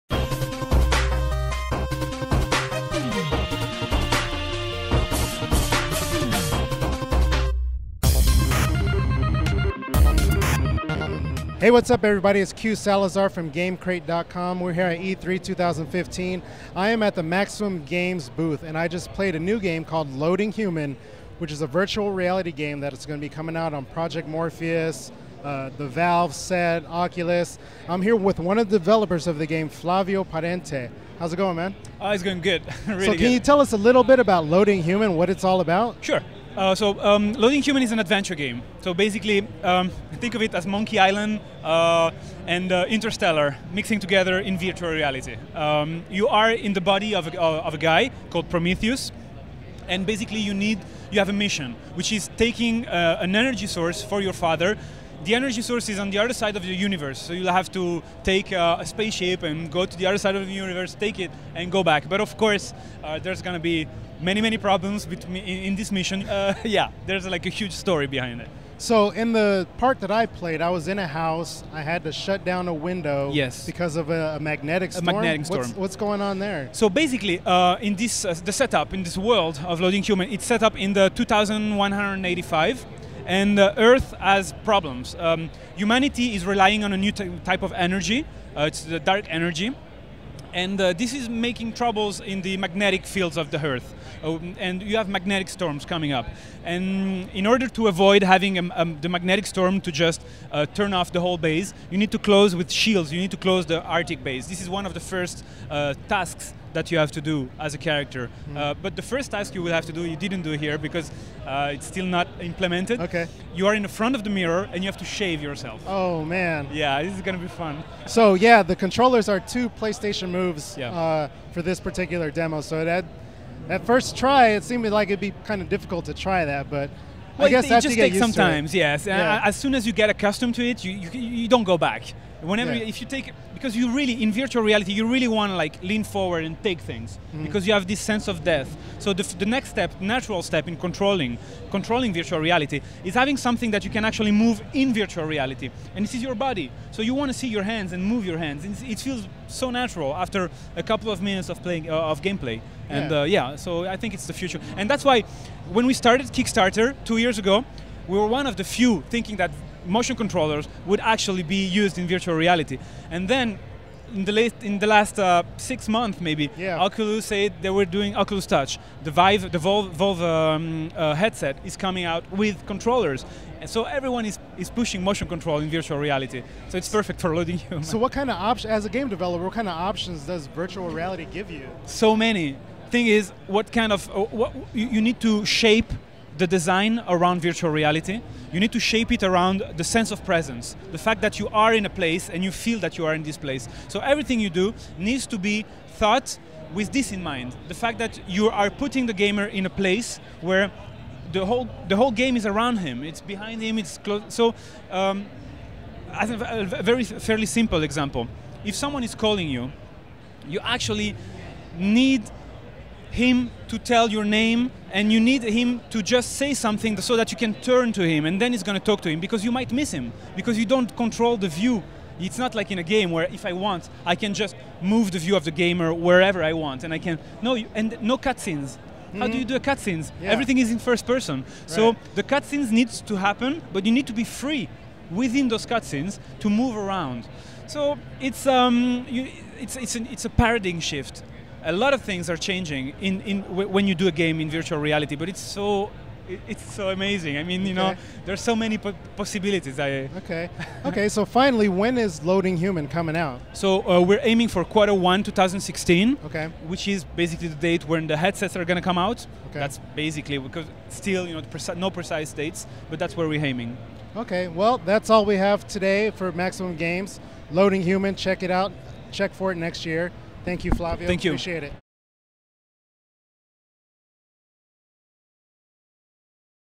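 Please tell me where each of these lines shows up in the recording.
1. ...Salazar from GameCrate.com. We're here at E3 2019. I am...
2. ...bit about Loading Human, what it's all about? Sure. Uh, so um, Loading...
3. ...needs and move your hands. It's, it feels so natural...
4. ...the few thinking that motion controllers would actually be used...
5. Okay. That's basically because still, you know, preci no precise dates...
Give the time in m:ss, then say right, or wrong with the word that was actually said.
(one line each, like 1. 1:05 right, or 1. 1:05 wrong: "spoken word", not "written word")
1. 0:12 wrong: "2015", not "2019"
2. 0:34 right
3. 2:27 wrong: "hands", not "needs"
4. 2:38 right
5. 4:19 right.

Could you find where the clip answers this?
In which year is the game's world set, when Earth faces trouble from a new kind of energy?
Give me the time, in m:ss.
1:21.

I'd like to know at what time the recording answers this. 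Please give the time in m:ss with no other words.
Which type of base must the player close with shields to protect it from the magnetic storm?
1:43.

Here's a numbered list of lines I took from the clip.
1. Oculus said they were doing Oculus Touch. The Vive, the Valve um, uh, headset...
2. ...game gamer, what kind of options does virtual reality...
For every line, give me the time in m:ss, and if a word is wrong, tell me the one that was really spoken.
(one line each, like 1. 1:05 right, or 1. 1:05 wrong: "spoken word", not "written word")
1. 2:46 right
2. 2:58 wrong: "developer", not "gamer".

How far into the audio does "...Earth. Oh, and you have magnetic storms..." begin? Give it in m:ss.
1:33.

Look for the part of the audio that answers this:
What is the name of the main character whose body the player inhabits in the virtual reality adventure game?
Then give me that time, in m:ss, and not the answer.
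0:48.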